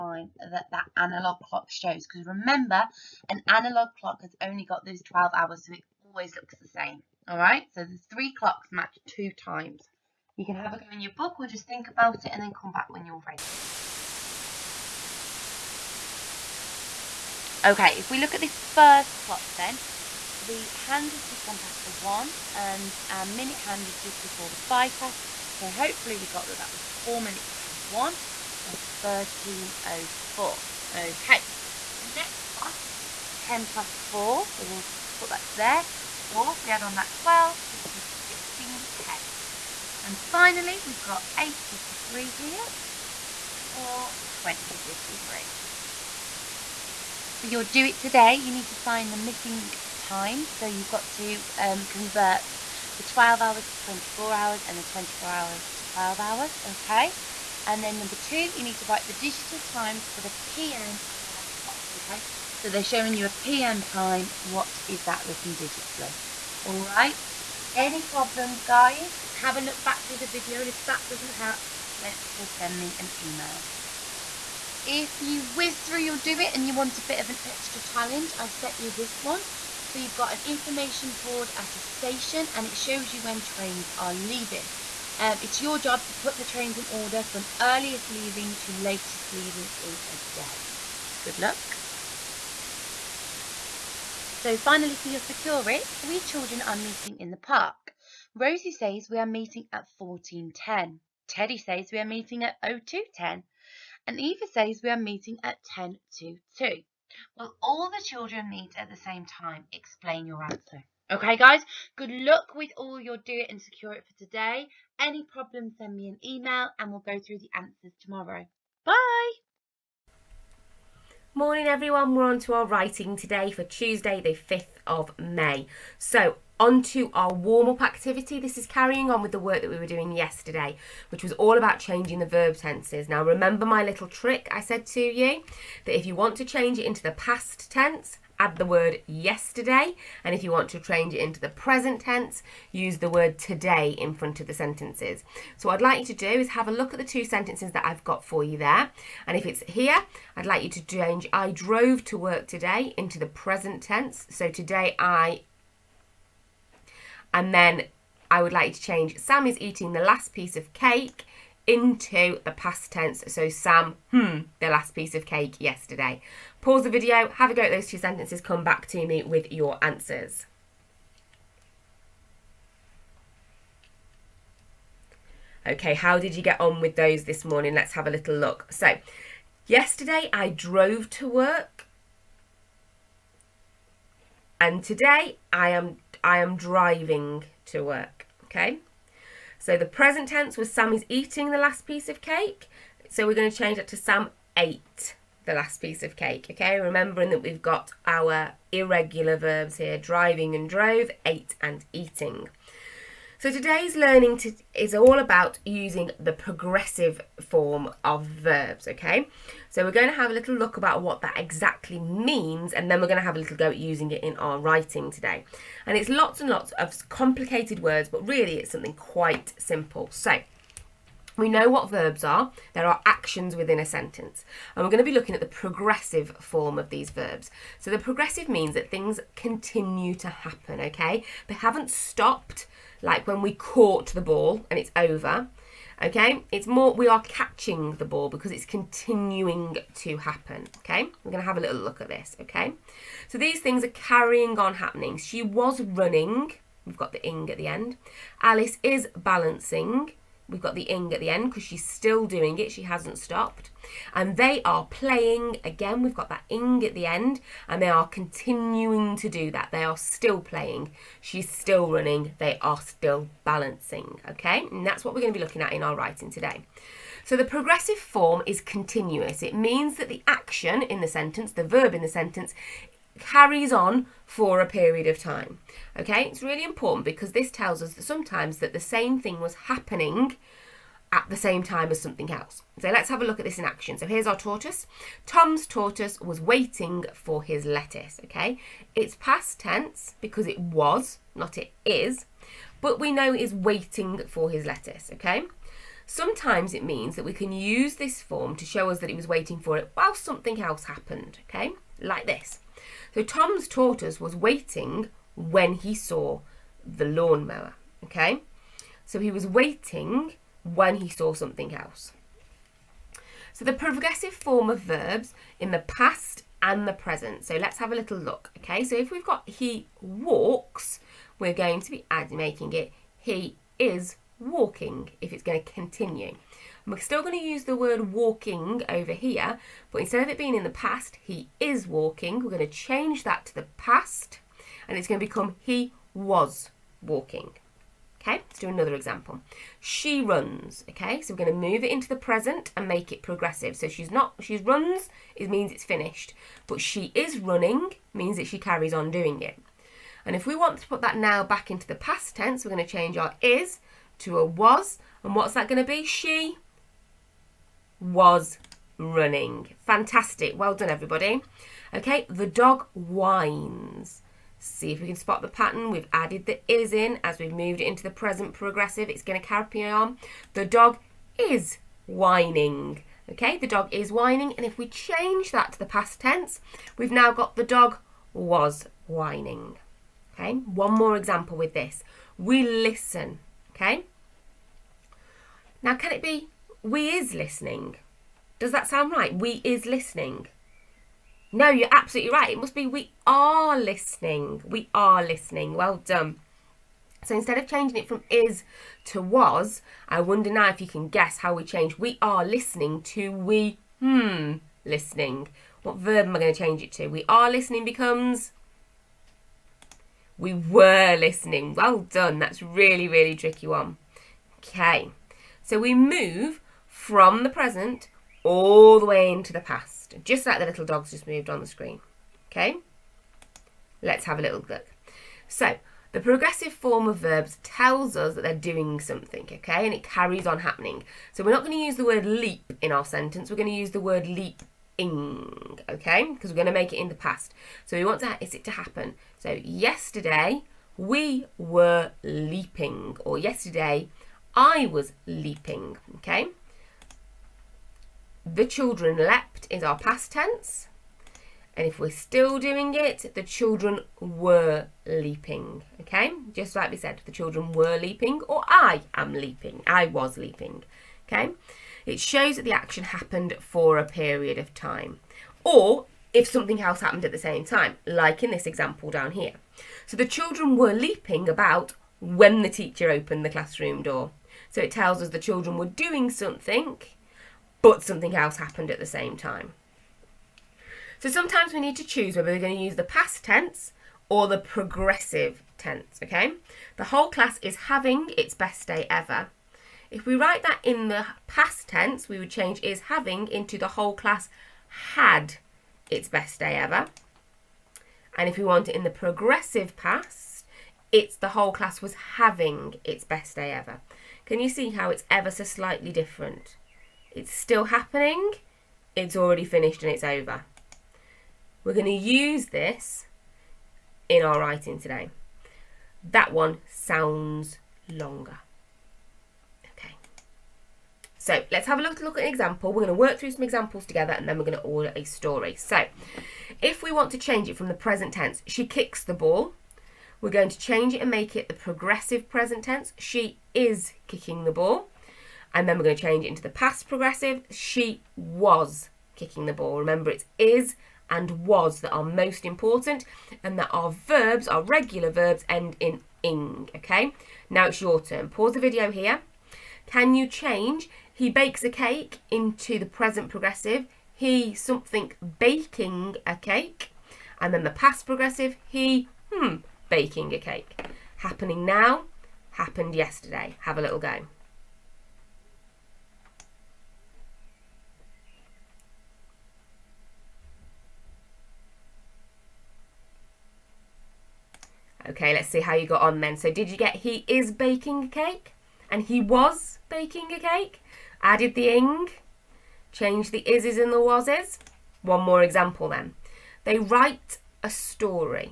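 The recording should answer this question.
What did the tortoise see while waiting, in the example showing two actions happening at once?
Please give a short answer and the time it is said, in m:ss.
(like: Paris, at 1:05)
the lawnmower, at 5:06.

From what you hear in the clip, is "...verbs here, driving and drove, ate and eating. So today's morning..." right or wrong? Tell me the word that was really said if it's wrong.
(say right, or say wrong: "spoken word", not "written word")
wrong: "learning", not "morning".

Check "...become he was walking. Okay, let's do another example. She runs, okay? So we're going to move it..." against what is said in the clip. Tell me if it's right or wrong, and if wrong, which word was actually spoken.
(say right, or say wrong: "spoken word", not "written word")
right.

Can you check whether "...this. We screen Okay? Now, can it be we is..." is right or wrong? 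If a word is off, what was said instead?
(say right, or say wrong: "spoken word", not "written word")
wrong: "listen", not "screen".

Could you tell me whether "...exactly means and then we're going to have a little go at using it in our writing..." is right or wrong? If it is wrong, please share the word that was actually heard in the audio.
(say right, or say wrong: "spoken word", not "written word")
right.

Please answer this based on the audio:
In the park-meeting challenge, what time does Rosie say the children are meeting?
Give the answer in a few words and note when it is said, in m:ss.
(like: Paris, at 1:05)
14.10, at 1:39.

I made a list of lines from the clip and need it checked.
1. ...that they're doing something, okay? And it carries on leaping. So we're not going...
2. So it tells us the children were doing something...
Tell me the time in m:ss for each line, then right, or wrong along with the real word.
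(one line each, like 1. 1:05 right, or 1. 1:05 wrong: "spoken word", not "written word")
1. 7:08 wrong: "happening", not "leaping"
2. 7:54 right.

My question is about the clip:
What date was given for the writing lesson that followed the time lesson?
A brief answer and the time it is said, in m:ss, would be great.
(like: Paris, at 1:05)
Tuesday the 5th of May, at 2:03.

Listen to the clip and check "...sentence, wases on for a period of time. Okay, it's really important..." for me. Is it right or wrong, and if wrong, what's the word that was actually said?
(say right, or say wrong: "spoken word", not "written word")
wrong: "carries", not "wases".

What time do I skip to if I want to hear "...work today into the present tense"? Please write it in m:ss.
2:32.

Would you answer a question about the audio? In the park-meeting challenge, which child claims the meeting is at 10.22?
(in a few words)
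Eva.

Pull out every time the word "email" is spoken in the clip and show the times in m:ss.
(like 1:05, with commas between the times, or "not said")
1:13, 1:56.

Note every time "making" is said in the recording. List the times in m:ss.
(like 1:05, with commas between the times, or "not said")
5:22.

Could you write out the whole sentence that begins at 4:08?
Alice is balancing, We've got the ing at the end because she's still doing it.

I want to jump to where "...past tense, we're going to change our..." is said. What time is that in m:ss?
5:51.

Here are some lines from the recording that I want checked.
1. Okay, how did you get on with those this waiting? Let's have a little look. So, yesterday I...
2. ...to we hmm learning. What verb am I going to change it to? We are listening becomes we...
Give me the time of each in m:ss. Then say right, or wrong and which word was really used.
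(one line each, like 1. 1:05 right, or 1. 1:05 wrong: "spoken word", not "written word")
1. 2:55 wrong: "morning", not "waiting"
2. 6:43 wrong: "listening", not "learning".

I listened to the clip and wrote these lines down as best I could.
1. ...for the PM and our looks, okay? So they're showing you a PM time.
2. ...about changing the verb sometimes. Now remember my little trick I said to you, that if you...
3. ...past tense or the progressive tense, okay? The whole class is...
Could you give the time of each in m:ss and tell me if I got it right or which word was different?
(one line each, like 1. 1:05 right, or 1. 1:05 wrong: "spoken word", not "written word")
1. 1:00 wrong: "clocks", not "looks"
2. 2:11 wrong: "tenses", not "sometimes"
3. 8:03 right.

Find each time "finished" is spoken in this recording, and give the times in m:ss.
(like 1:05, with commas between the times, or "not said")
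5:45, 8:29.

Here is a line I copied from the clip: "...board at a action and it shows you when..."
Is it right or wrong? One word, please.
wrong.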